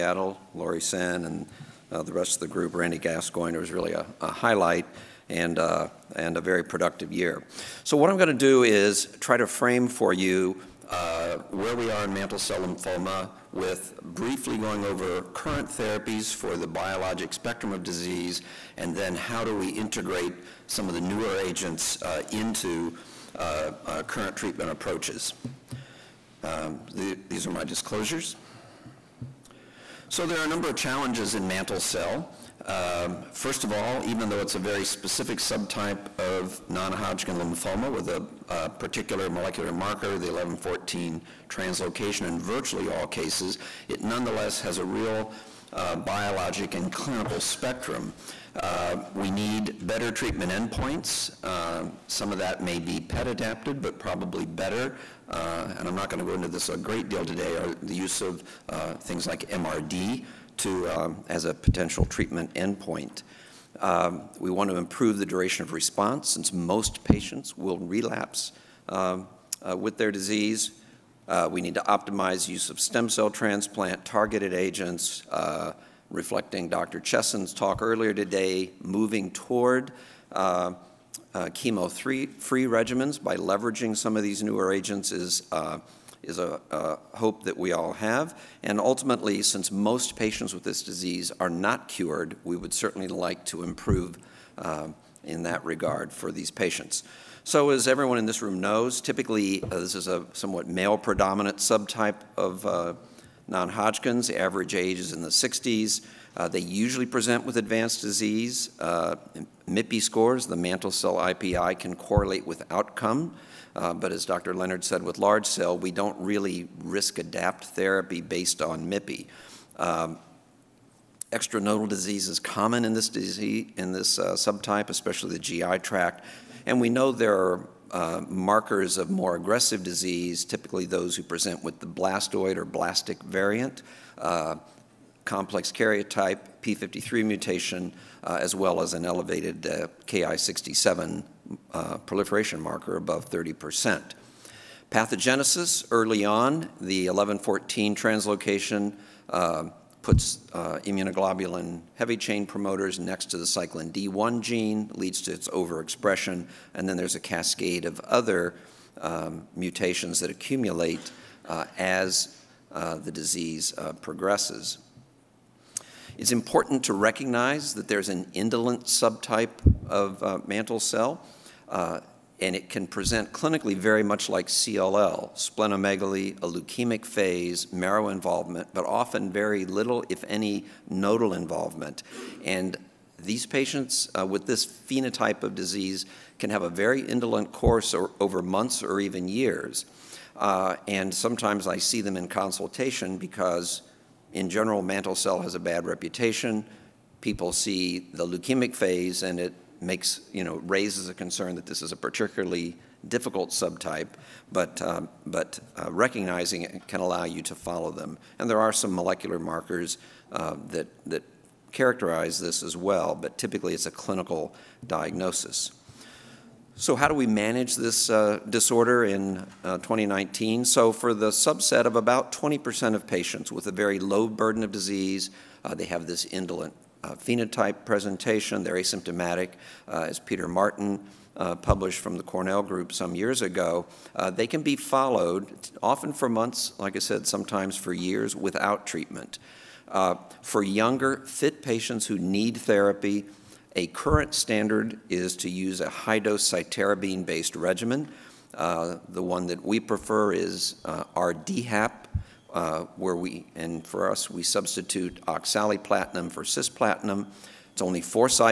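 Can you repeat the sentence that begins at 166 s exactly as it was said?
It's important to recognize that there's an indolent subtype of uh, mantle cell.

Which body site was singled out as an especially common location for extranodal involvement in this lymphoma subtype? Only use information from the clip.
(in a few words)
GI tract.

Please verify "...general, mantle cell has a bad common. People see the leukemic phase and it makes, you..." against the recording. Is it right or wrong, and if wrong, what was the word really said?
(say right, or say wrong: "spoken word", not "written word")
wrong: "reputation", not "common".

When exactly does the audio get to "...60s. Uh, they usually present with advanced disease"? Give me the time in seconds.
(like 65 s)
105 s.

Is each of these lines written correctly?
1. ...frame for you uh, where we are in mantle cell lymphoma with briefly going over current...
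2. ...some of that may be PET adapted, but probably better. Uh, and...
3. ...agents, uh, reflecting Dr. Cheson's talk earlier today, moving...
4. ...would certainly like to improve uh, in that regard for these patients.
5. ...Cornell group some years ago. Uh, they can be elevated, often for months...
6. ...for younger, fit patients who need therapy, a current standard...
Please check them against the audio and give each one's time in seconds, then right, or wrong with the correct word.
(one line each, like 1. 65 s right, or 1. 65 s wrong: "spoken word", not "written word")
1. 9 s right
2. 52 s right
3. 74 s right
4. 92 s right
5. 232 s wrong: "followed", not "elevated"
6. 240 s right.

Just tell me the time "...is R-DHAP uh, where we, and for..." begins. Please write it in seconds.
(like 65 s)
250 s.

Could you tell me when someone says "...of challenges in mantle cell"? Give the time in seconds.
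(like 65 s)
30 s.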